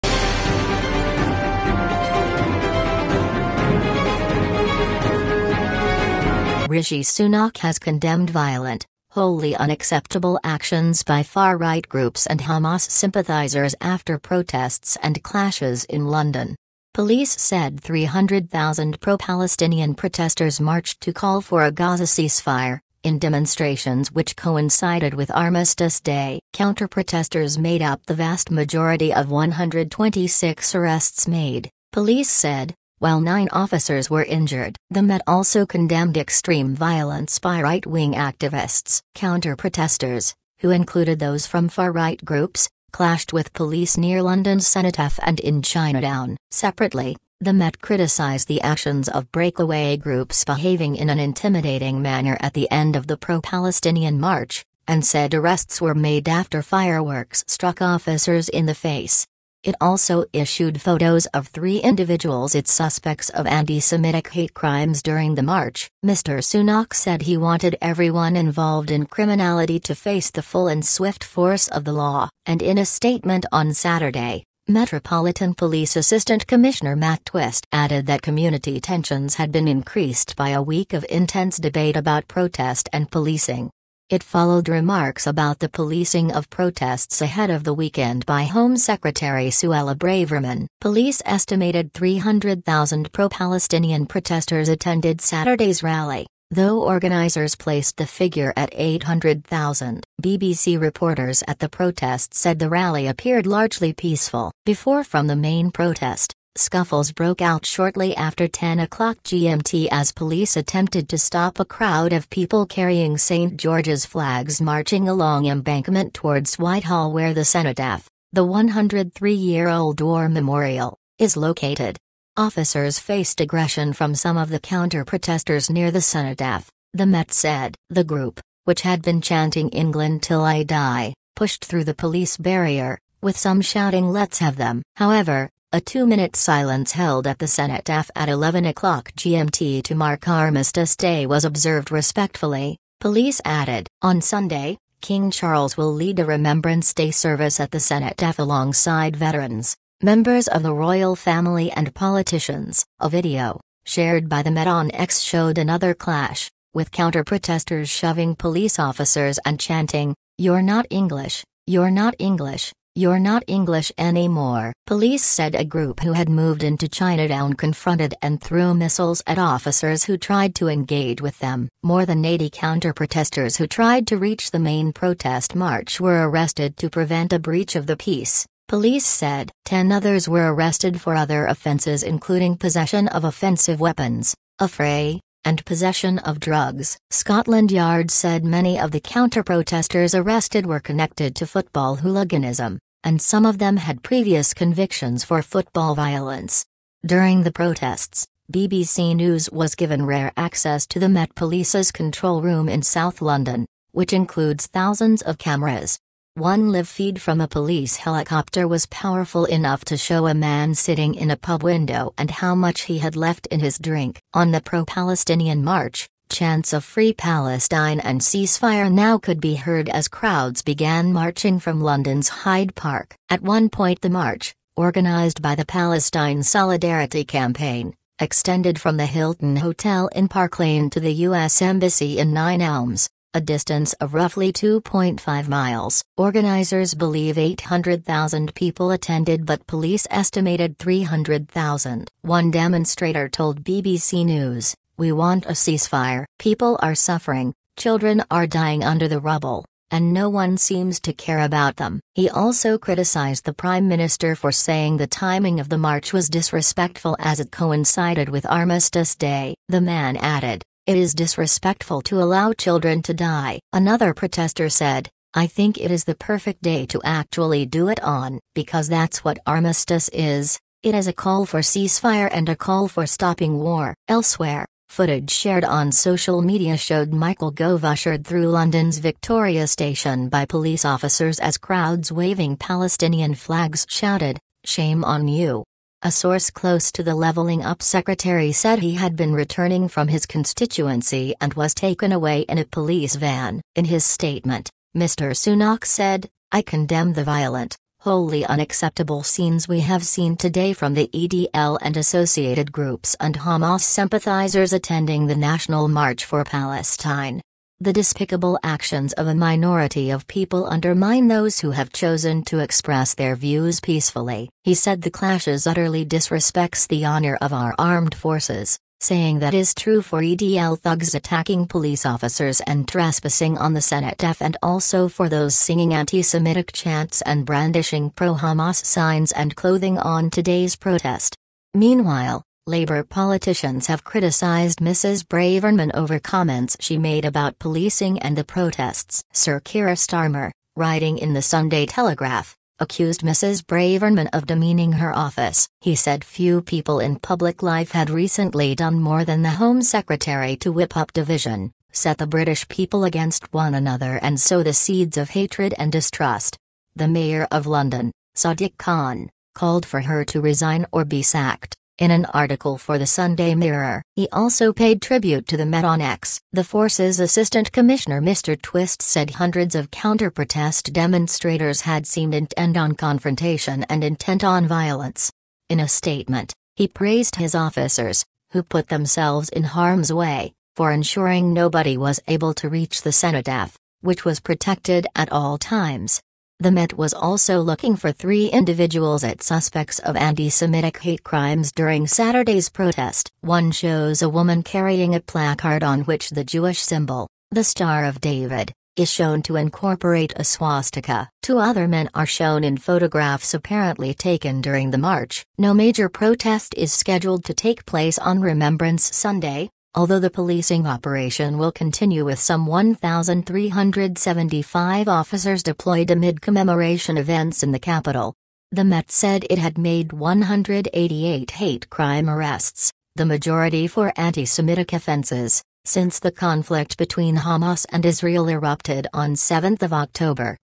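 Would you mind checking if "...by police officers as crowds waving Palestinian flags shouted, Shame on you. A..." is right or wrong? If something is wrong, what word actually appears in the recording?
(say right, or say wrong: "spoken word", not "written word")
right.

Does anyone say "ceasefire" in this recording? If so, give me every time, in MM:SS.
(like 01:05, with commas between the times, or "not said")
00:22, 03:38, 04:05, 04:31.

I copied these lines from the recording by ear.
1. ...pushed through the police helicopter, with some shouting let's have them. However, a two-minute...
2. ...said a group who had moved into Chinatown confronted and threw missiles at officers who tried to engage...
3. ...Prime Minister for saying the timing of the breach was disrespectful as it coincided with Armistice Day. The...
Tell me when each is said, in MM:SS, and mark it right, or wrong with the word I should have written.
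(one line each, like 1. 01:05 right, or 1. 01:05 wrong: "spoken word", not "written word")
1. 02:11 wrong: "barrier", not "helicopter"
2. 02:45 right
3. 04:13 wrong: "march", not "breach".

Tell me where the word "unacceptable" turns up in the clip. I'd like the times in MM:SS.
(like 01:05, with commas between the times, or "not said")
00:09, 04:58.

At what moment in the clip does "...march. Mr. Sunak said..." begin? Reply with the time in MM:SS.
01:05.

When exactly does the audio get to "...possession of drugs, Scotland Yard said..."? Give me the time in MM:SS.
03:05.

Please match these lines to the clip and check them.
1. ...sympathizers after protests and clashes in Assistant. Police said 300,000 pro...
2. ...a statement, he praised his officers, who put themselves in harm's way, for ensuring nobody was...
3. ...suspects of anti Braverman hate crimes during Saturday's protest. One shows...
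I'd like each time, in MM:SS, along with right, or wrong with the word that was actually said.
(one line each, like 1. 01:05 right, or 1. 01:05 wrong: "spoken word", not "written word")
1. 00:12 wrong: "London", not "Assistant"
2. 06:15 right
3. 06:29 wrong: "Semitic", not "Braverman".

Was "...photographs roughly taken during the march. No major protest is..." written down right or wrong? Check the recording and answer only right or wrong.
wrong.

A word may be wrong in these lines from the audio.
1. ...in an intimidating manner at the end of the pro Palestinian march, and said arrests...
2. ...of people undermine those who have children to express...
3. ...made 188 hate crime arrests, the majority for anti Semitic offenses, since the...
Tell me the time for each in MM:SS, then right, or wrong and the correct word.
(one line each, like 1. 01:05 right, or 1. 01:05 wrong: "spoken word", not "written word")
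1. 00:50 right
2. 05:10 wrong: "chosen", not "children"
3. 06:59 right.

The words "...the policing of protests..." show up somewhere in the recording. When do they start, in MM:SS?
01:25.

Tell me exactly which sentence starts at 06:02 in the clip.
In an article for the Sunday Mirror, he also paid tribute to the Met on X.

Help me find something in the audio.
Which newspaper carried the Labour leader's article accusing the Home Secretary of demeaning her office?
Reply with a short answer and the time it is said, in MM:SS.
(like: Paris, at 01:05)
Sunday Telegraph, at 05:41.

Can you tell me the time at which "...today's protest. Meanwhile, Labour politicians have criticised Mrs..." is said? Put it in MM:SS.
05:30.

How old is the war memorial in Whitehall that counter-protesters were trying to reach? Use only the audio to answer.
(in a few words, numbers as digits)
103 years.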